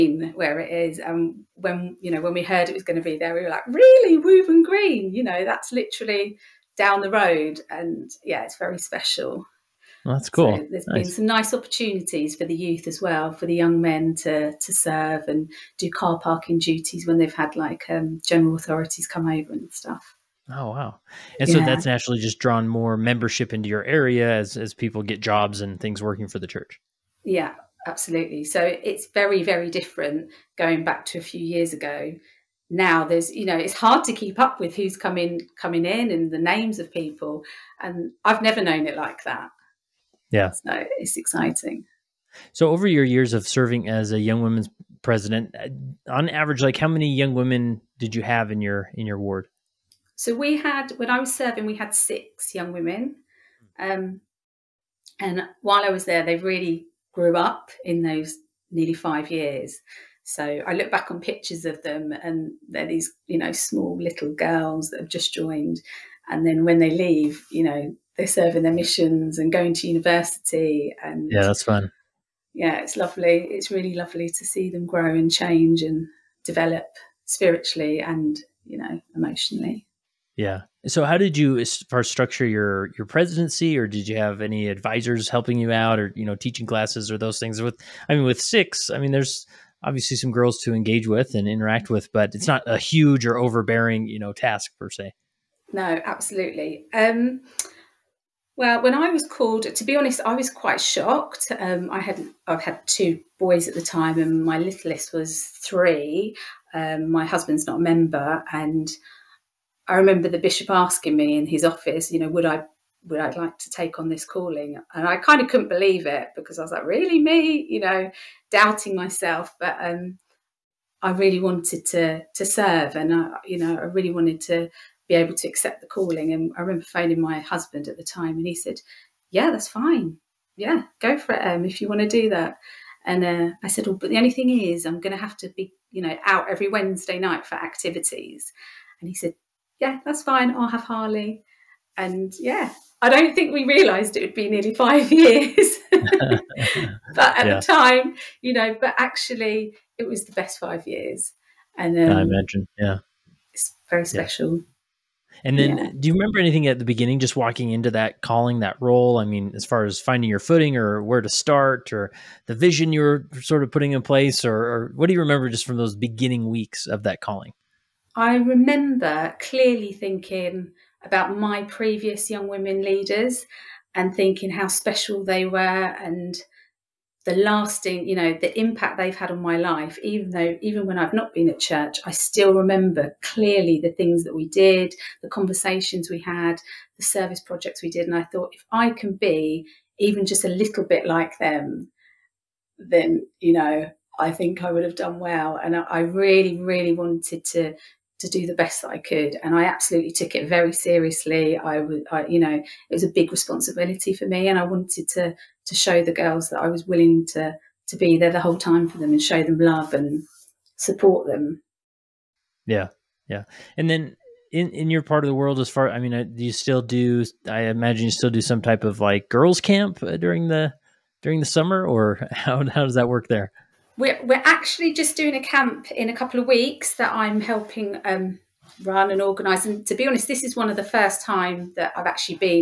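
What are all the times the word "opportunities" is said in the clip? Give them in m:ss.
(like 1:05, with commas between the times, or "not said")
0:11.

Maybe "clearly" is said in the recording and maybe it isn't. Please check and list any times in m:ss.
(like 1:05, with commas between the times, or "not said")
2:49, 3:03.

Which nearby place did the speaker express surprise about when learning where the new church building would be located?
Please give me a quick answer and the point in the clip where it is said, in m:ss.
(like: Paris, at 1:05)
Wooburn Green, at 0:04.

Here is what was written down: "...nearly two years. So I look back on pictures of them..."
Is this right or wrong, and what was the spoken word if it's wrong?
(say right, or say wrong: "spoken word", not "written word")
wrong: "five", not "two".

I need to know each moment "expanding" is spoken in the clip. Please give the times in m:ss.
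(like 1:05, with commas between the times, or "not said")
not said.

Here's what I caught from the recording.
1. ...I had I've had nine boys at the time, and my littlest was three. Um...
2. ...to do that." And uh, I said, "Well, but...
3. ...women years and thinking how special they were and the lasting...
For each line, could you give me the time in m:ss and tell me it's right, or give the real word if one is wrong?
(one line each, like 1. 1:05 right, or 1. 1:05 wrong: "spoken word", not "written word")
1. 1:41 wrong: "two", not "nine"
2. 2:12 right
3. 2:52 wrong: "leaders", not "years".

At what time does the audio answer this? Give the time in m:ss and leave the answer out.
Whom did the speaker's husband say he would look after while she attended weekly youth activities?
2:20.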